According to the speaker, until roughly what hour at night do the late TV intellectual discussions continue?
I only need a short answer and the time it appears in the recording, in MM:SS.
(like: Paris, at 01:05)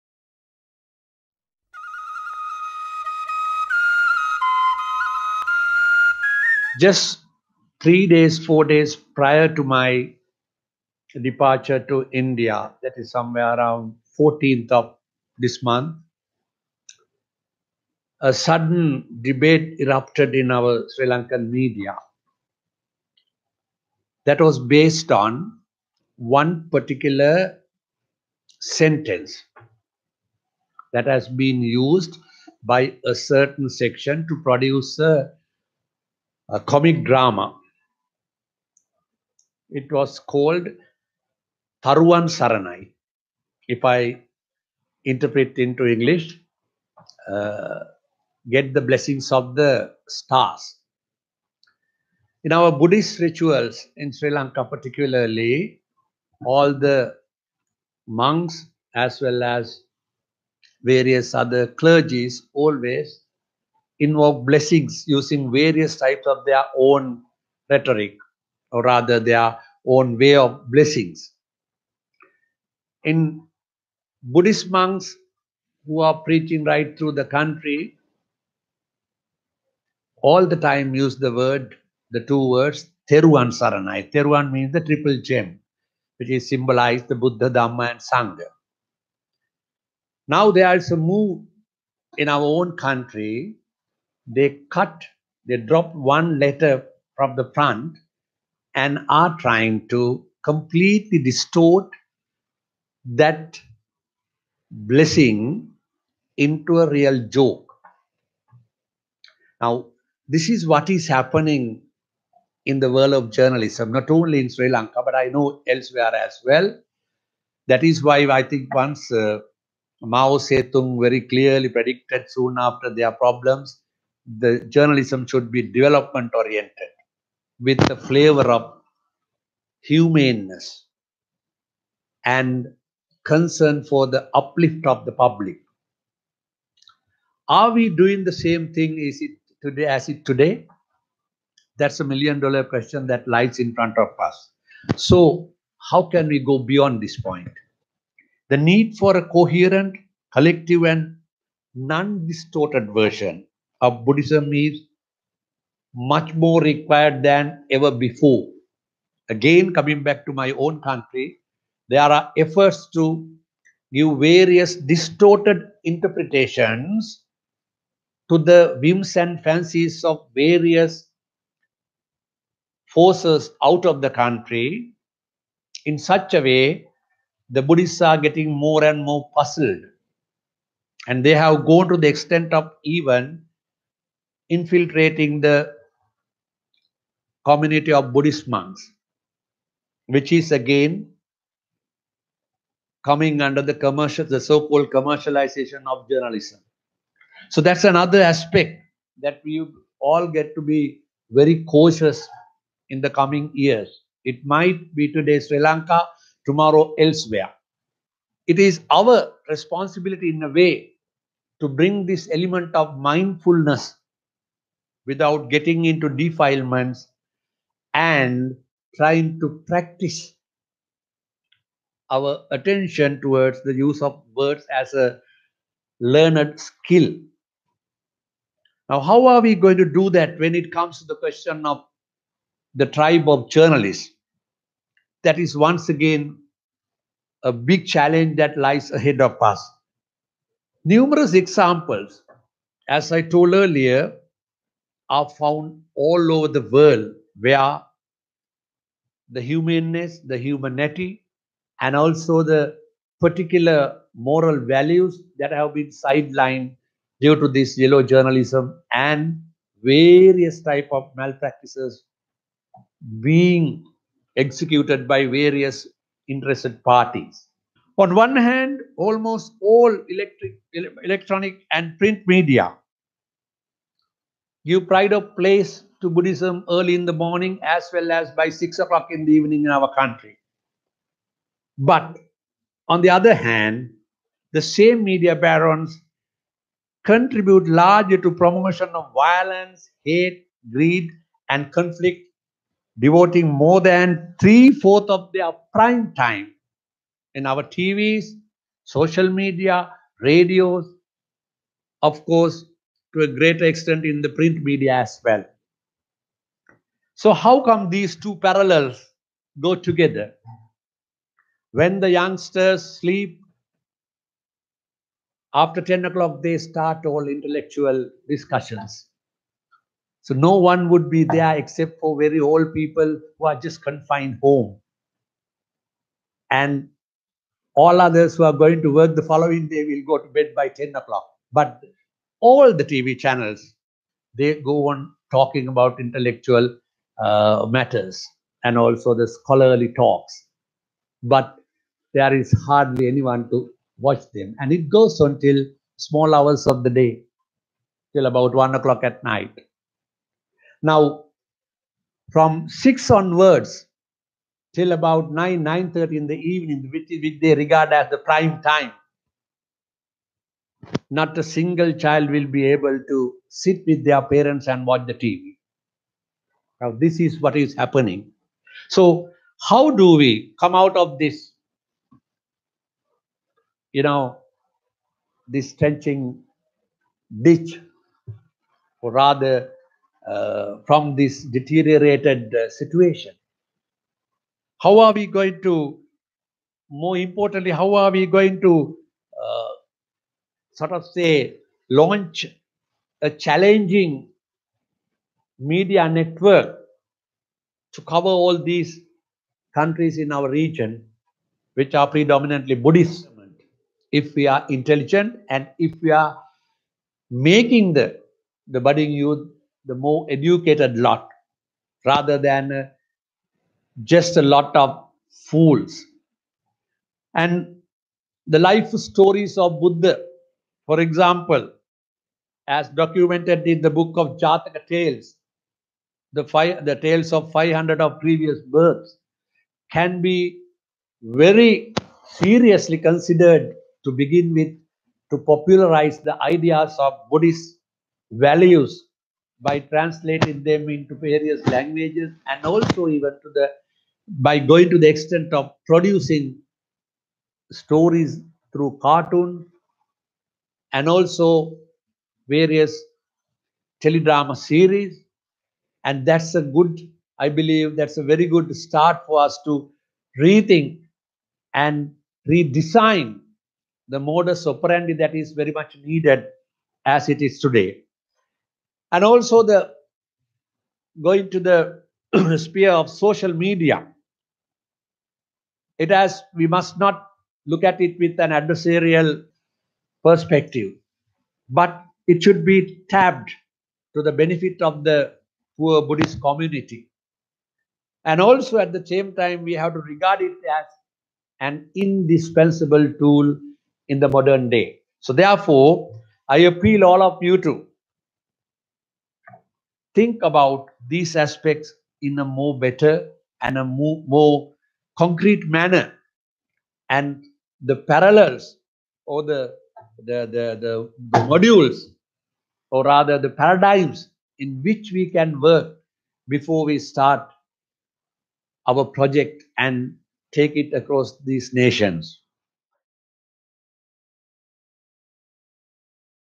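1 o'clock, at 05:48.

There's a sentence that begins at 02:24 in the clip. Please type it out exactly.
So how can we go beyond this point?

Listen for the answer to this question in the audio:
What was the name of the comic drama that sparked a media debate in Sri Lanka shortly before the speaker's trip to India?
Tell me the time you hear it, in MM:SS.
00:41.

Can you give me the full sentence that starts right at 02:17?
Are we doing the same thing is it today as it today?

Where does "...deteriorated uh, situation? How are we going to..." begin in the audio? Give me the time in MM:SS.
06:21.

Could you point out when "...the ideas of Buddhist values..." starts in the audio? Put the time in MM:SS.
07:16.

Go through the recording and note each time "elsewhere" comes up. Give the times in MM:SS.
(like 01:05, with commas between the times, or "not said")
01:55, 03:26.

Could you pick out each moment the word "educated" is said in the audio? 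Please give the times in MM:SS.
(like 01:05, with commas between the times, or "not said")
06:50.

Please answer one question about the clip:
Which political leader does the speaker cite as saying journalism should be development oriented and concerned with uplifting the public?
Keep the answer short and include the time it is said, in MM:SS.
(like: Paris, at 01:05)
Mao Zedong, at 02:00.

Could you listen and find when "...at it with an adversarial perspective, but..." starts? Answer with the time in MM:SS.
07:57.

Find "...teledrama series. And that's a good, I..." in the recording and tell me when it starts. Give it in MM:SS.
07:34.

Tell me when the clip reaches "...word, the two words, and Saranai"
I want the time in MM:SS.
01:21.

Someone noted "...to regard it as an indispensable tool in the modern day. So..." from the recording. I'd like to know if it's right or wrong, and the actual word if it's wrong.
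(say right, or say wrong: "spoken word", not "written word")
right.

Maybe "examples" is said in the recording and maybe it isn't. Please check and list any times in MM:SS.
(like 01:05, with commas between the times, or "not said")
04:01, 07:00.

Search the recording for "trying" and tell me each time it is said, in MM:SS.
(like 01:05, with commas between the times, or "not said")
01:39, 03:38.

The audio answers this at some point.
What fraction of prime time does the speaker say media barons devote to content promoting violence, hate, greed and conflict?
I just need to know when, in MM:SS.
04:54.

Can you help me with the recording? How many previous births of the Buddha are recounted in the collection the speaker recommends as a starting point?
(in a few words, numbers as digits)
500.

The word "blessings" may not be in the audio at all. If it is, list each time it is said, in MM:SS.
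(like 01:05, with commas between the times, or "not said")
00:48, 01:04, 01:10, 01:44.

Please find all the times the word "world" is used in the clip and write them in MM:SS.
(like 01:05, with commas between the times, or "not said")
01:52, 04:06.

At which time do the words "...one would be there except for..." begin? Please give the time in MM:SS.
05:20.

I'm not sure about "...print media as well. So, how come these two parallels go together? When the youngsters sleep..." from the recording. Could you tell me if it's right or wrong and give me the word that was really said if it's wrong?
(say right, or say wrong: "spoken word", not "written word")
right.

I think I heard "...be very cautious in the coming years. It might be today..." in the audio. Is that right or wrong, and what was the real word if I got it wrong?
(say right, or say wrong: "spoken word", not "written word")
right.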